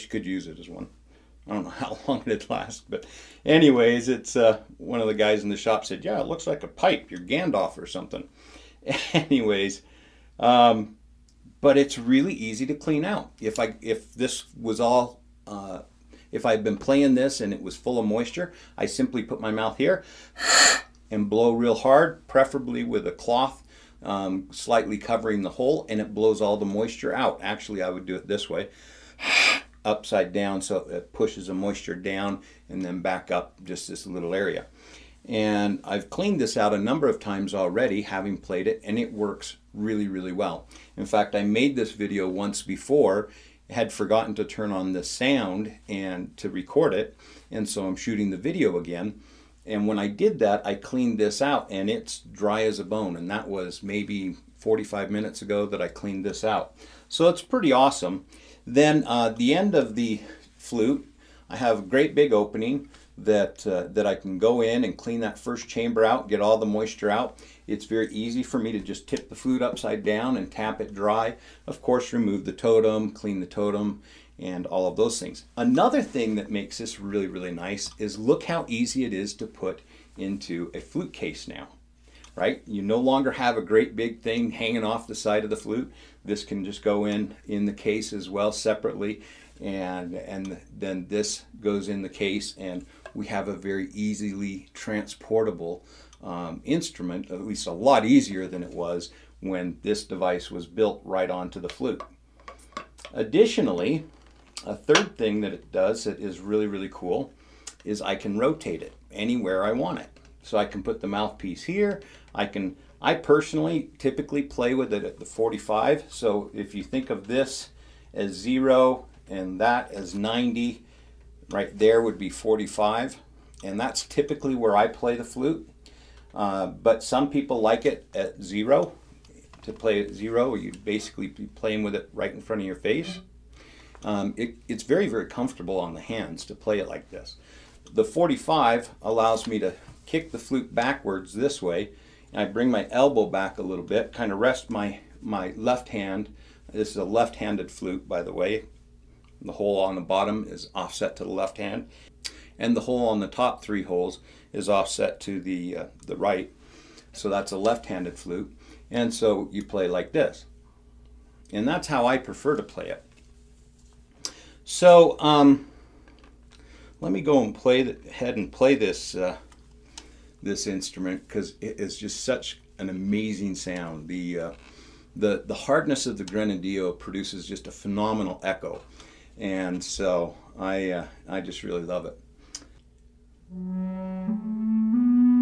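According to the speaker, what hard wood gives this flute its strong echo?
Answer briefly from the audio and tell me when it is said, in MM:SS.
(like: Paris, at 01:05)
Grenadillo, at 02:56.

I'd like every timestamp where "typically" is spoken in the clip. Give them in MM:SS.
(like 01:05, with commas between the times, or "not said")
01:53, 02:04.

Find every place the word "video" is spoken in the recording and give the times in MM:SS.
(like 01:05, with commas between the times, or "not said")
00:41, 00:48.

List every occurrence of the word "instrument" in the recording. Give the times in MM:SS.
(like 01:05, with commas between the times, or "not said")
01:36, 02:50.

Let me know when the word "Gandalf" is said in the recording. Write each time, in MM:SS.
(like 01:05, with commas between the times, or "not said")
00:07.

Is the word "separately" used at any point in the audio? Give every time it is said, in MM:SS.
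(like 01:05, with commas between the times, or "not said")
01:28.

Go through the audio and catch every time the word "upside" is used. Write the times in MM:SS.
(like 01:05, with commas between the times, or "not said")
00:29, 01:09.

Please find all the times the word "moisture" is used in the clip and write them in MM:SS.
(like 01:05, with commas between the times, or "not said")
00:18, 00:26, 00:31, 01:06.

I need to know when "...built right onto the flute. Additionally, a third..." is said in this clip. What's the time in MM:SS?
01:40.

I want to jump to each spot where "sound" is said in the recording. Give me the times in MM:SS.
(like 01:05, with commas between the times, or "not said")
00:45, 02:53.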